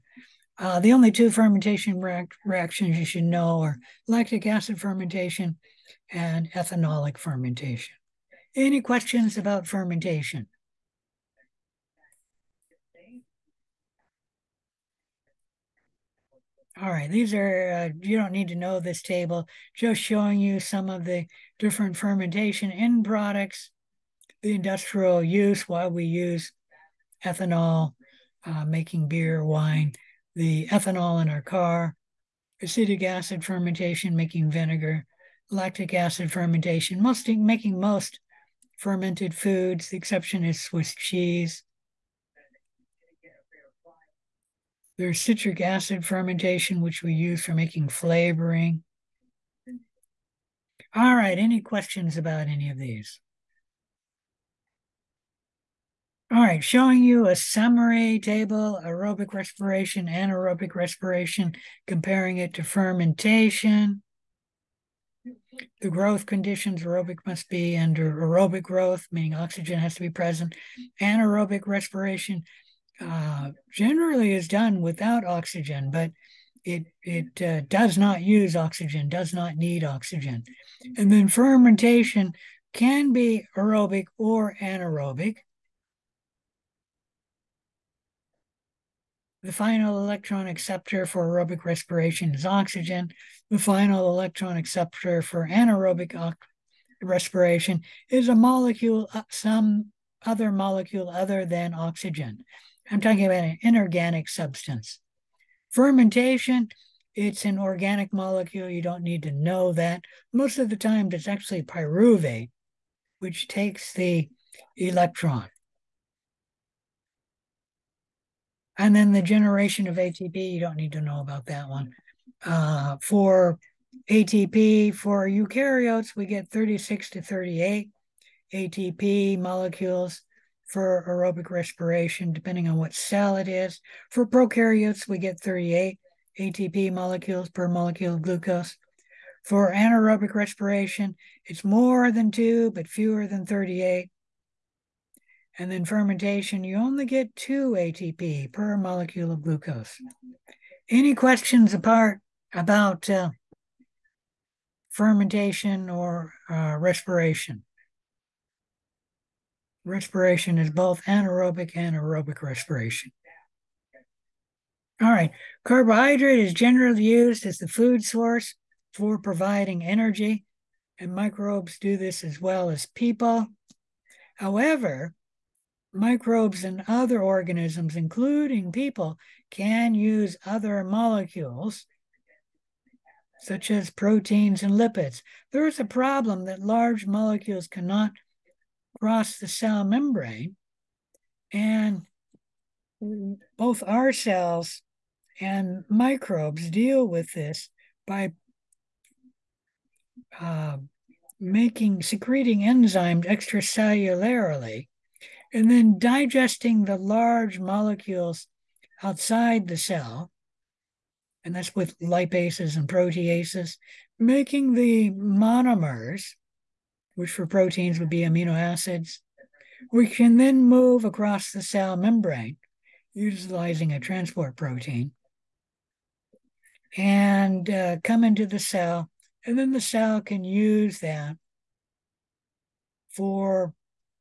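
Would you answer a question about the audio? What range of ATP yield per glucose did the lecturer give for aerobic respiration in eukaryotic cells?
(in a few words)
36 to 38.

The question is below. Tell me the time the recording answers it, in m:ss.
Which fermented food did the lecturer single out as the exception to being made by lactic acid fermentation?
0:40.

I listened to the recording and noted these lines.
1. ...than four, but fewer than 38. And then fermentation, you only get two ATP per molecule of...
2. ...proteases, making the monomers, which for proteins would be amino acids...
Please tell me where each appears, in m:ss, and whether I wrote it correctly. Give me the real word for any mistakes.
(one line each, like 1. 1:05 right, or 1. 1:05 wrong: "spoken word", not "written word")
1. 2:22 wrong: "two", not "four"
2. 3:32 right.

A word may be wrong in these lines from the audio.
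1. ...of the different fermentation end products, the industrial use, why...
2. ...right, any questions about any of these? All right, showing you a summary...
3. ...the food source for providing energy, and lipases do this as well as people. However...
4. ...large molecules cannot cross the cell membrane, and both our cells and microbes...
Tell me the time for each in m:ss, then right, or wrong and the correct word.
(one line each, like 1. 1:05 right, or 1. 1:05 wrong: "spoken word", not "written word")
1. 0:20 right
2. 0:51 right
3. 2:47 wrong: "microbes", not "lipases"
4. 3:06 right.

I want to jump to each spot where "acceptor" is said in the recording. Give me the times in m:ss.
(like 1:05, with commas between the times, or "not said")
1:30, 1:34.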